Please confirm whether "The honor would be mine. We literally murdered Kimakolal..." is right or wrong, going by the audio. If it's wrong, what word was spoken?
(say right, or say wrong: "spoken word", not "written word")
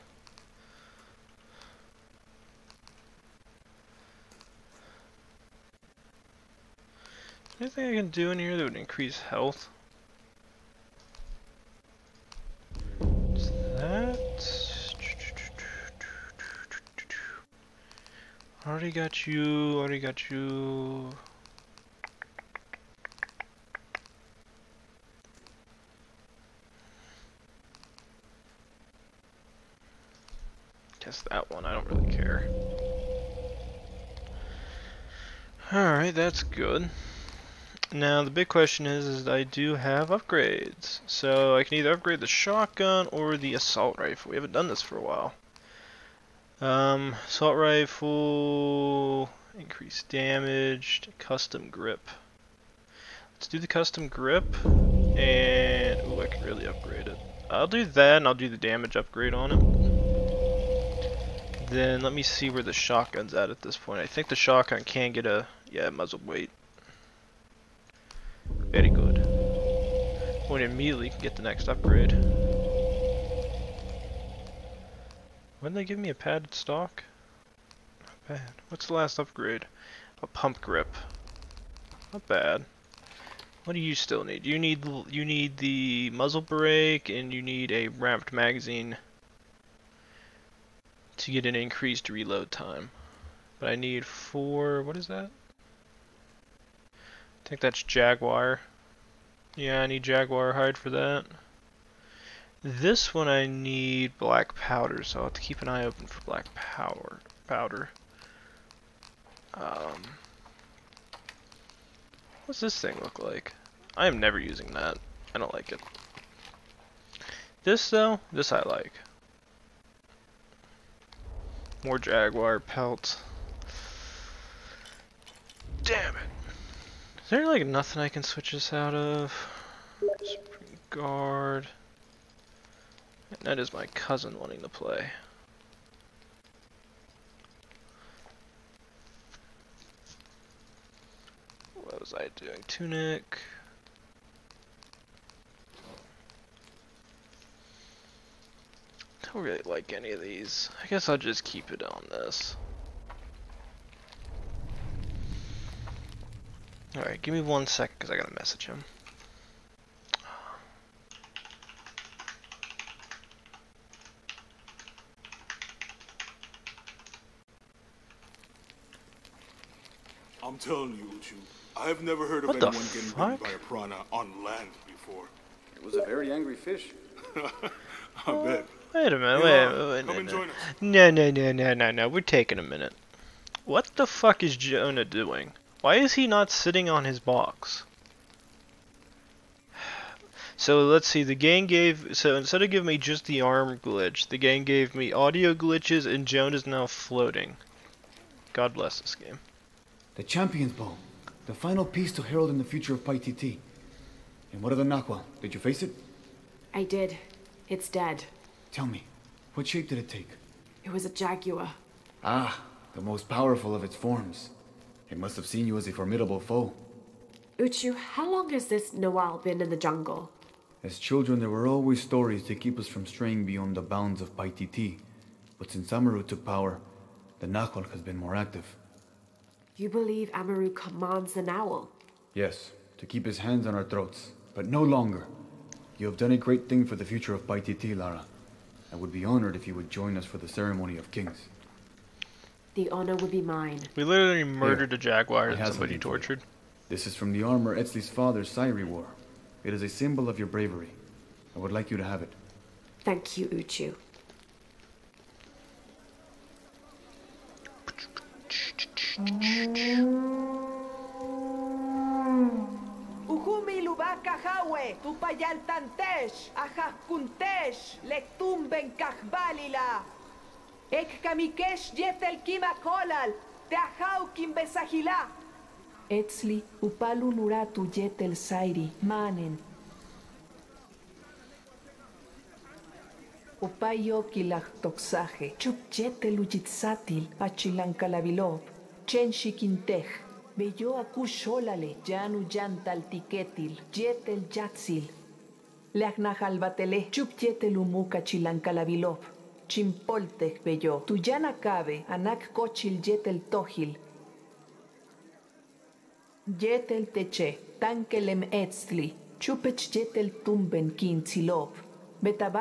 wrong: "Here", not "Kimakolal".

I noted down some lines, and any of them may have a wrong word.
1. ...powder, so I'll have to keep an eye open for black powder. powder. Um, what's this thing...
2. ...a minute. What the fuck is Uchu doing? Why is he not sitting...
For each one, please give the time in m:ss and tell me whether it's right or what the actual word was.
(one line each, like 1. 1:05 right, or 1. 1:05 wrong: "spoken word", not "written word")
1. 1:44 right
2. 3:02 wrong: "Jonah", not "Uchu".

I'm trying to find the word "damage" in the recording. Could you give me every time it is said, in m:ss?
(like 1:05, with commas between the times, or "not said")
0:50, 0:58.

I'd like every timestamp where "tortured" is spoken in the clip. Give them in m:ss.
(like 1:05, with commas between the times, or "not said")
4:05.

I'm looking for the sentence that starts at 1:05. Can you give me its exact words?
Yeah, it might as well wait.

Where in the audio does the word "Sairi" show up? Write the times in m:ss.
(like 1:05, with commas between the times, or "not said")
4:08, 4:38.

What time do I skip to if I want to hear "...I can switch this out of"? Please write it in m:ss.
2:08.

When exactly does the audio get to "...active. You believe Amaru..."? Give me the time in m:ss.
3:48.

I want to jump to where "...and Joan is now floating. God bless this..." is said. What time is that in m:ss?
3:16.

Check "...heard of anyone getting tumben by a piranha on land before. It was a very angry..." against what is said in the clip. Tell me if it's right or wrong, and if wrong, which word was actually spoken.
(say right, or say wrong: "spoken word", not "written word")
wrong: "bitten", not "tumben".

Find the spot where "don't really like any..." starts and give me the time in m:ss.
2:29.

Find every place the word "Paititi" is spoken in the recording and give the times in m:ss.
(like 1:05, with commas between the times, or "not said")
3:44, 3:57.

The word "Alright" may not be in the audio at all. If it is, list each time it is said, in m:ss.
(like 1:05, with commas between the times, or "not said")
0:35, 2:36.